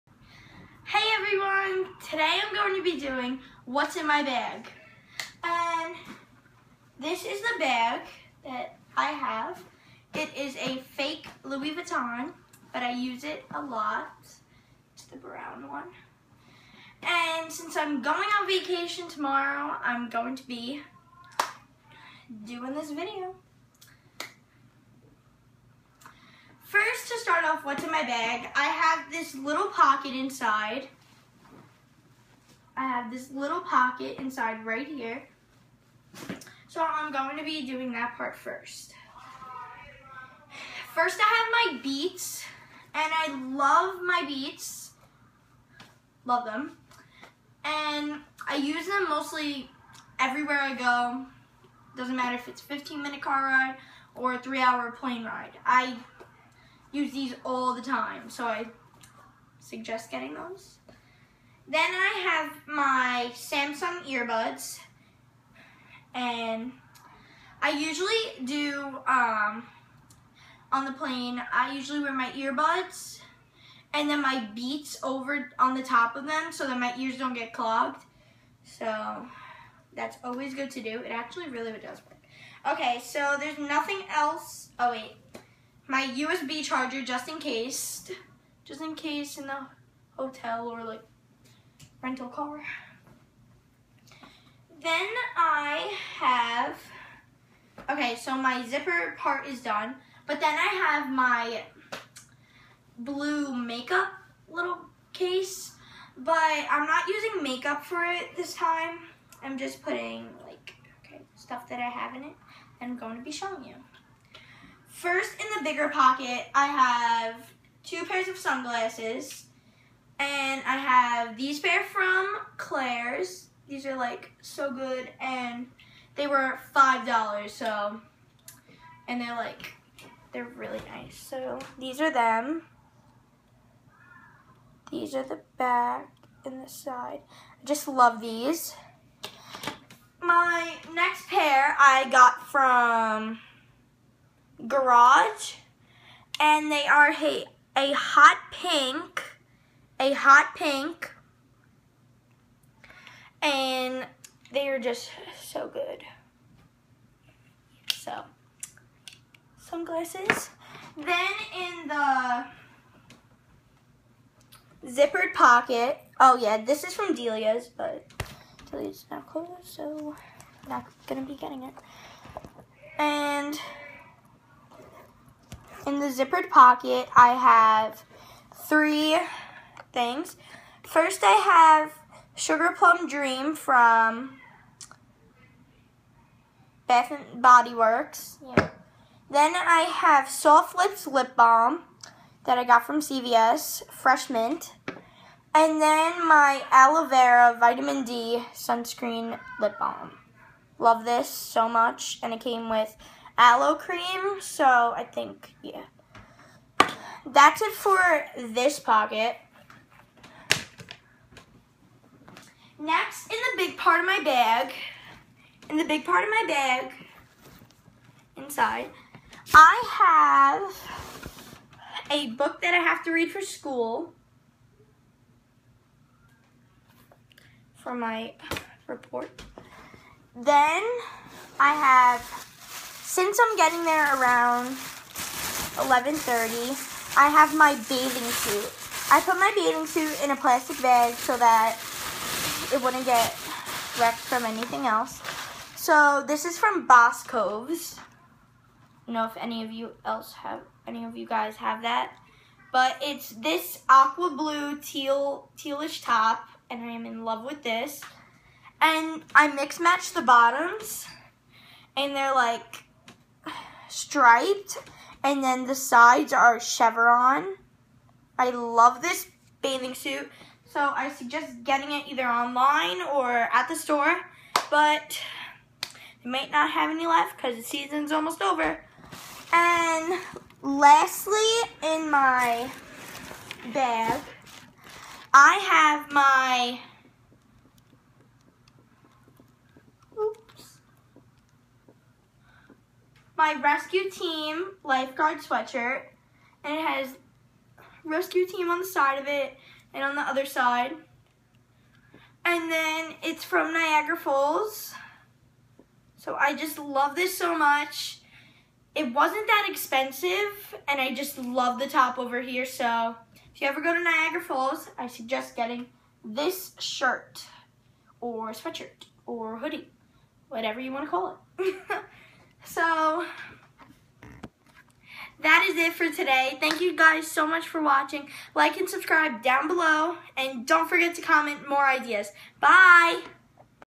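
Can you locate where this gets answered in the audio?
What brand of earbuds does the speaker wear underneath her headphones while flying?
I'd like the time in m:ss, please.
1:03.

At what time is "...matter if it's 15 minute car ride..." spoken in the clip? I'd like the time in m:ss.
0:52.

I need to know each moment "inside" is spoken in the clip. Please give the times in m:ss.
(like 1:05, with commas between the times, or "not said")
0:30, 0:34, 3:38.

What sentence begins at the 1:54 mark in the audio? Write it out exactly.
First, in the bigger pocket, I have two pairs of sunglasses, and I have these pair from Claire's.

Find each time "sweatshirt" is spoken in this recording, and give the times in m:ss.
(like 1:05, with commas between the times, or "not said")
4:55, 5:18.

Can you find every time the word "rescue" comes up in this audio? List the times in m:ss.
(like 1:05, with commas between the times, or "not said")
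4:53, 4:58.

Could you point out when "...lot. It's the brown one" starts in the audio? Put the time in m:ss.
0:13.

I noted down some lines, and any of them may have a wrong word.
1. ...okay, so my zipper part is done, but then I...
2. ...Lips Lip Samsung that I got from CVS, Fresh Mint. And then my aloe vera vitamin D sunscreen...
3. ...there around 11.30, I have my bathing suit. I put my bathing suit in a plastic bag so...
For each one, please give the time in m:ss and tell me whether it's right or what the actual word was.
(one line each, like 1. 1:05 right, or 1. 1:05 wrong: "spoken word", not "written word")
1. 1:37 right
2. 3:10 wrong: "Balm", not "Samsung"
3. 3:53 right.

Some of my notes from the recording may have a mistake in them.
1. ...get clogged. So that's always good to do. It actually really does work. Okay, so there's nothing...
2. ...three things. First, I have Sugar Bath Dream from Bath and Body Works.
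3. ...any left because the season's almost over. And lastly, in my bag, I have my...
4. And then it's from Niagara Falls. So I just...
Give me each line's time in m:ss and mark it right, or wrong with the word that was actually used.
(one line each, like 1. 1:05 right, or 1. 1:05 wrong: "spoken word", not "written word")
1. 1:17 right
2. 2:58 wrong: "Plum", not "Bath"
3. 4:36 right
4. 5:02 right.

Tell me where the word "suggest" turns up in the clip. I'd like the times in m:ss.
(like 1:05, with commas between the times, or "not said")
0:59, 4:31, 5:15.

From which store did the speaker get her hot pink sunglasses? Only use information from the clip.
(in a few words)
Garage.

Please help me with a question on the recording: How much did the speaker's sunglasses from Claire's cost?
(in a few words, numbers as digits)
$5.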